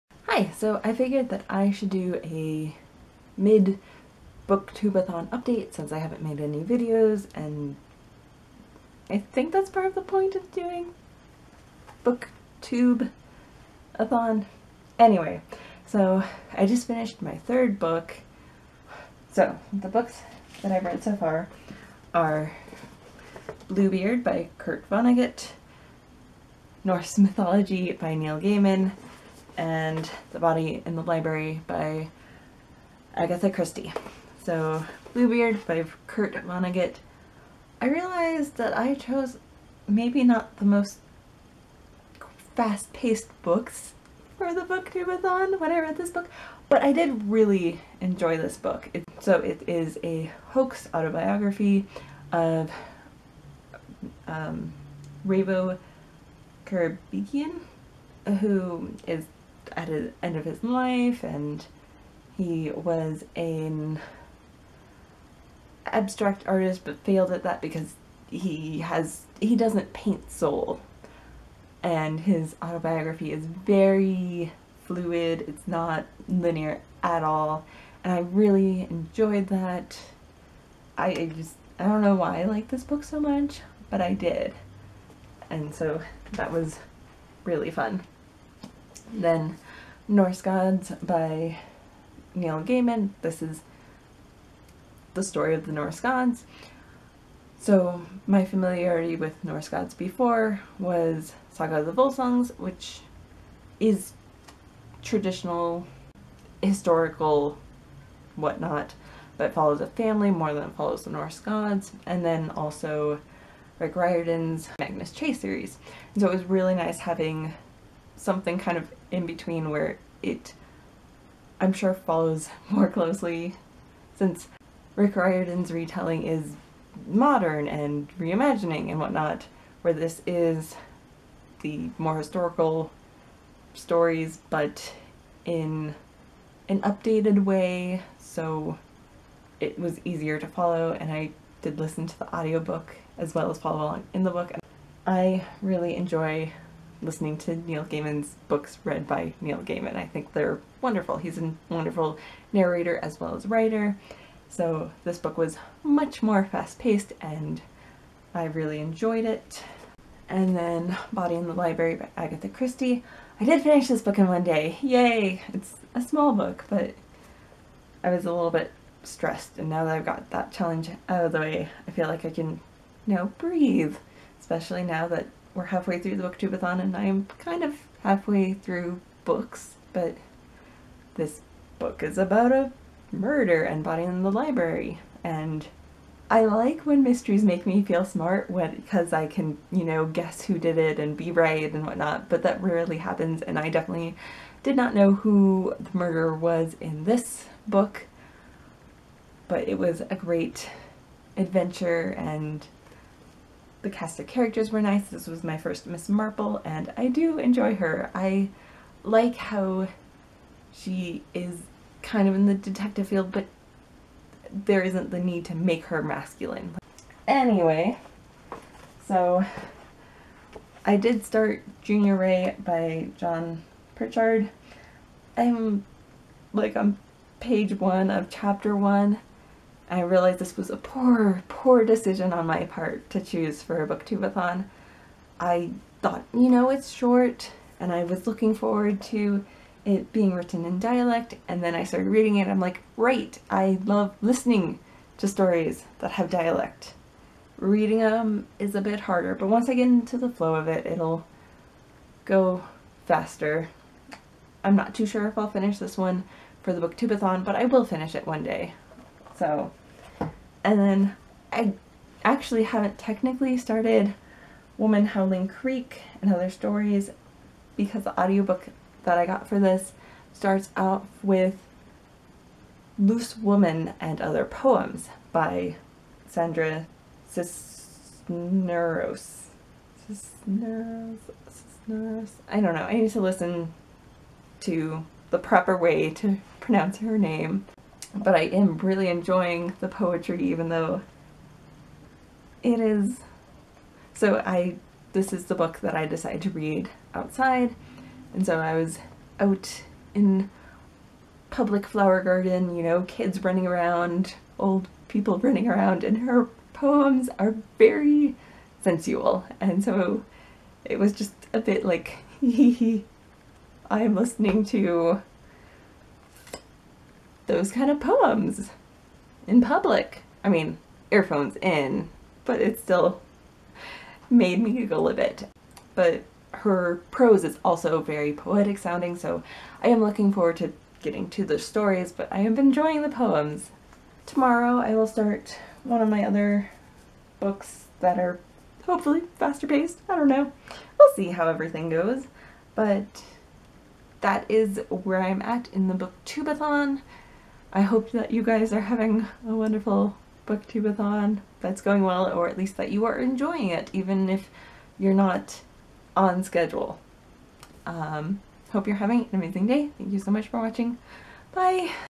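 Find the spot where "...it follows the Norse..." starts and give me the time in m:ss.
1:50.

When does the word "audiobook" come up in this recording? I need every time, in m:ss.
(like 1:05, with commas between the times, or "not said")
2:22, 4:28.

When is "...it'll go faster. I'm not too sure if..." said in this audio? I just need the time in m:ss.
4:10.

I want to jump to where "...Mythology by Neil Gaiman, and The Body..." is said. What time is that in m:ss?
0:27.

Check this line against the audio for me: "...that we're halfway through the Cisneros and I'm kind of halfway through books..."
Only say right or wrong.
wrong.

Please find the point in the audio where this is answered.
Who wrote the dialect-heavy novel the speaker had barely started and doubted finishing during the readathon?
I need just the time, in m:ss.
3:43.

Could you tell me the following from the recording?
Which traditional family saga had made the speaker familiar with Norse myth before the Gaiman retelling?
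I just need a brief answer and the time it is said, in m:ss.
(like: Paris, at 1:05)
Saga of the Volsungs, at 1:41.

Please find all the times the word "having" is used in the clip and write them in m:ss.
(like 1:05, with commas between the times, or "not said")
1:56, 5:48, 5:58.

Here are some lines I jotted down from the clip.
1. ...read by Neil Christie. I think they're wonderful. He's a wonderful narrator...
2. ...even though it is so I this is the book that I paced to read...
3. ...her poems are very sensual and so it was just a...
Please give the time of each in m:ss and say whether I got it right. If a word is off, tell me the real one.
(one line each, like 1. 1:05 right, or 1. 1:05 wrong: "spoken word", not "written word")
1. 2:28 wrong: "Gaiman", not "Christie"
2. 4:50 wrong: "decided", not "paced"
3. 5:06 right.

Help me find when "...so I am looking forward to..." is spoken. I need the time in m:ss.
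5:29.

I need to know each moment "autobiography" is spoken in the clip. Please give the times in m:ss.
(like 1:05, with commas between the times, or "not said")
0:50, 1:12.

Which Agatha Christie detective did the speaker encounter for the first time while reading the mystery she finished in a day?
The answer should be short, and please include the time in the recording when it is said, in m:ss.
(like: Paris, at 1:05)
Miss Marple, at 3:25.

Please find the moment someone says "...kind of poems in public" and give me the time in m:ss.
5:17.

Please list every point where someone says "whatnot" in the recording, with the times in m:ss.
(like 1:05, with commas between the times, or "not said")
1:48, 2:08, 3:11.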